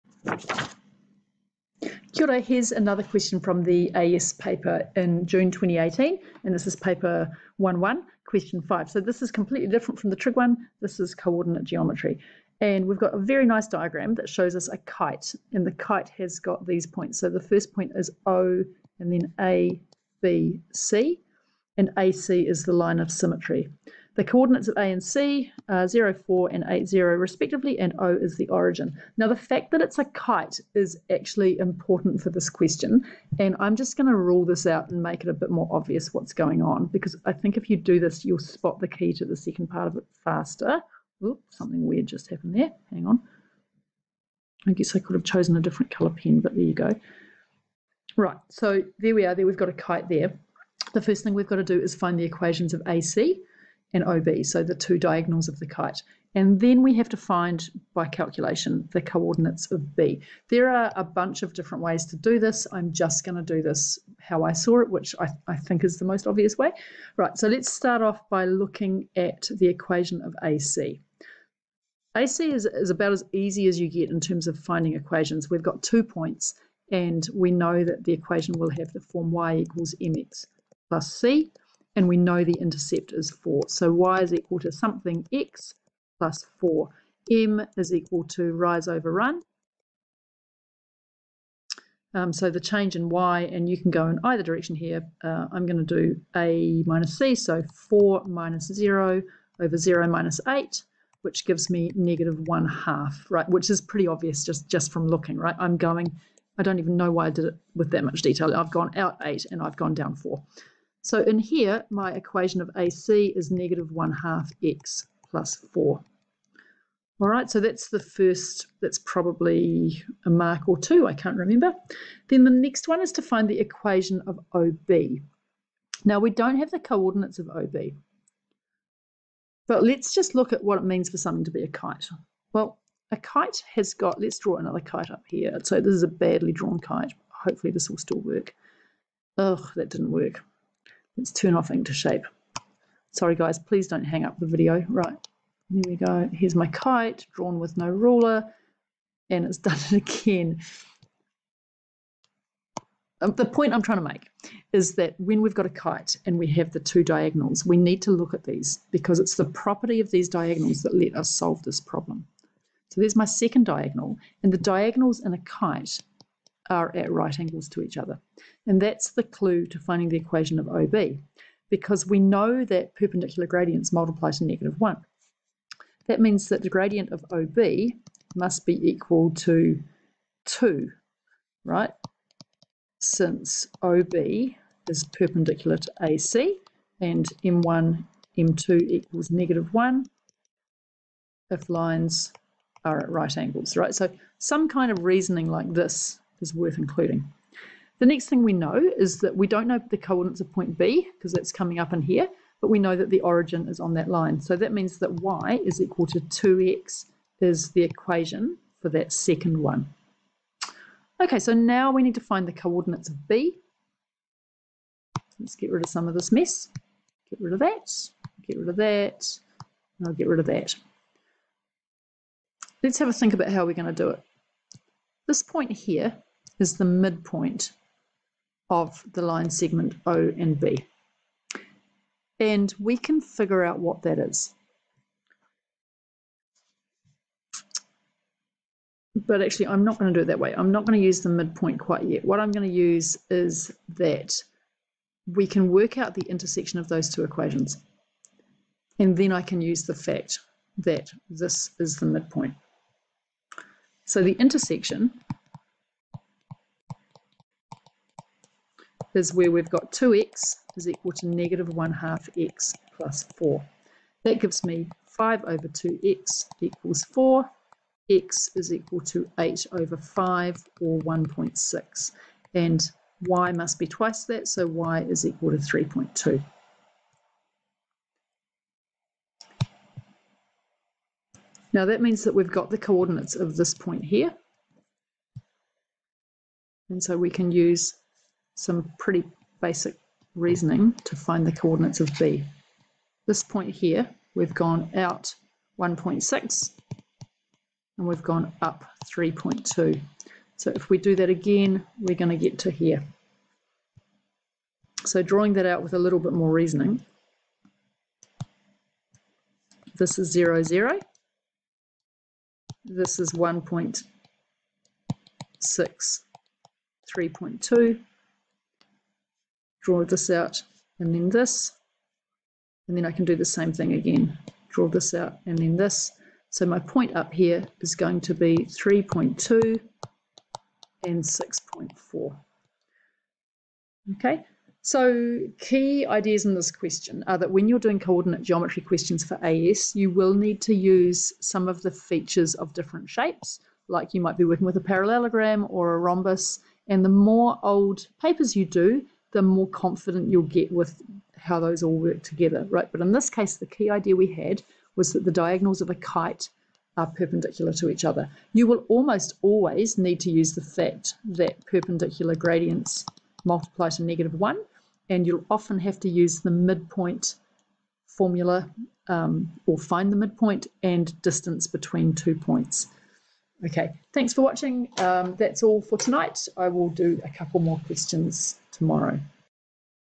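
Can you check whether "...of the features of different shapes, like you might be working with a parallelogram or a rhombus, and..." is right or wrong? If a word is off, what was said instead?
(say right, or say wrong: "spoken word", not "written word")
right.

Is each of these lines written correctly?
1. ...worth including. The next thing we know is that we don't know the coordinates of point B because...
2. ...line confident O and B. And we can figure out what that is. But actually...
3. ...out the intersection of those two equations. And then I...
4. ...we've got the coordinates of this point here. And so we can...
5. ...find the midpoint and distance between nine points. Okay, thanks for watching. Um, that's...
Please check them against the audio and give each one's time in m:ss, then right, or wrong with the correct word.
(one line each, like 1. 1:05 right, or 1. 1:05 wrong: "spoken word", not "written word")
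1. 3:16 right
2. 3:49 wrong: "segment", not "confident"
3. 4:05 right
4. 4:42 right
5. 6:09 wrong: "two", not "nine".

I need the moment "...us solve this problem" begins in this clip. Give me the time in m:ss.
2:41.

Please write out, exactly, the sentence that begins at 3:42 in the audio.
Let's have a think about how we're going to do it.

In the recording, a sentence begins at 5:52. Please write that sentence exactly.
But in this case, the key idea we had was that the diagonals of a kite are perpendicular to each other.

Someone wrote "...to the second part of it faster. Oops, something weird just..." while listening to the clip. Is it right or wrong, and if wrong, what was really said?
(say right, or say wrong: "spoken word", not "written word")
right.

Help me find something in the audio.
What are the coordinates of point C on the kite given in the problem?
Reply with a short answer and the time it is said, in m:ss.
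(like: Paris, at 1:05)
8, 0, at 0:26.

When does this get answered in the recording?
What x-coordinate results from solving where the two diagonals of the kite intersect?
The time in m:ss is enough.
4:29.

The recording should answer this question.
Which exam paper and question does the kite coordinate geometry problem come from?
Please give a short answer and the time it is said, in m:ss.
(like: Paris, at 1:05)
Paper 1-1, question 5, at 0:06.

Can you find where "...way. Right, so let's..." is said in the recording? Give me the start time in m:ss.
1:06.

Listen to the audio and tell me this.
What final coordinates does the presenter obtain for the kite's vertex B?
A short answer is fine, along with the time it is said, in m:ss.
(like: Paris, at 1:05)
(3.2, 6.4), at 5:28.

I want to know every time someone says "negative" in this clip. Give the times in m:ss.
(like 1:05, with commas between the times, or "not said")
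1:41, 1:53, 2:54, 3:09, 4:21, 6:04.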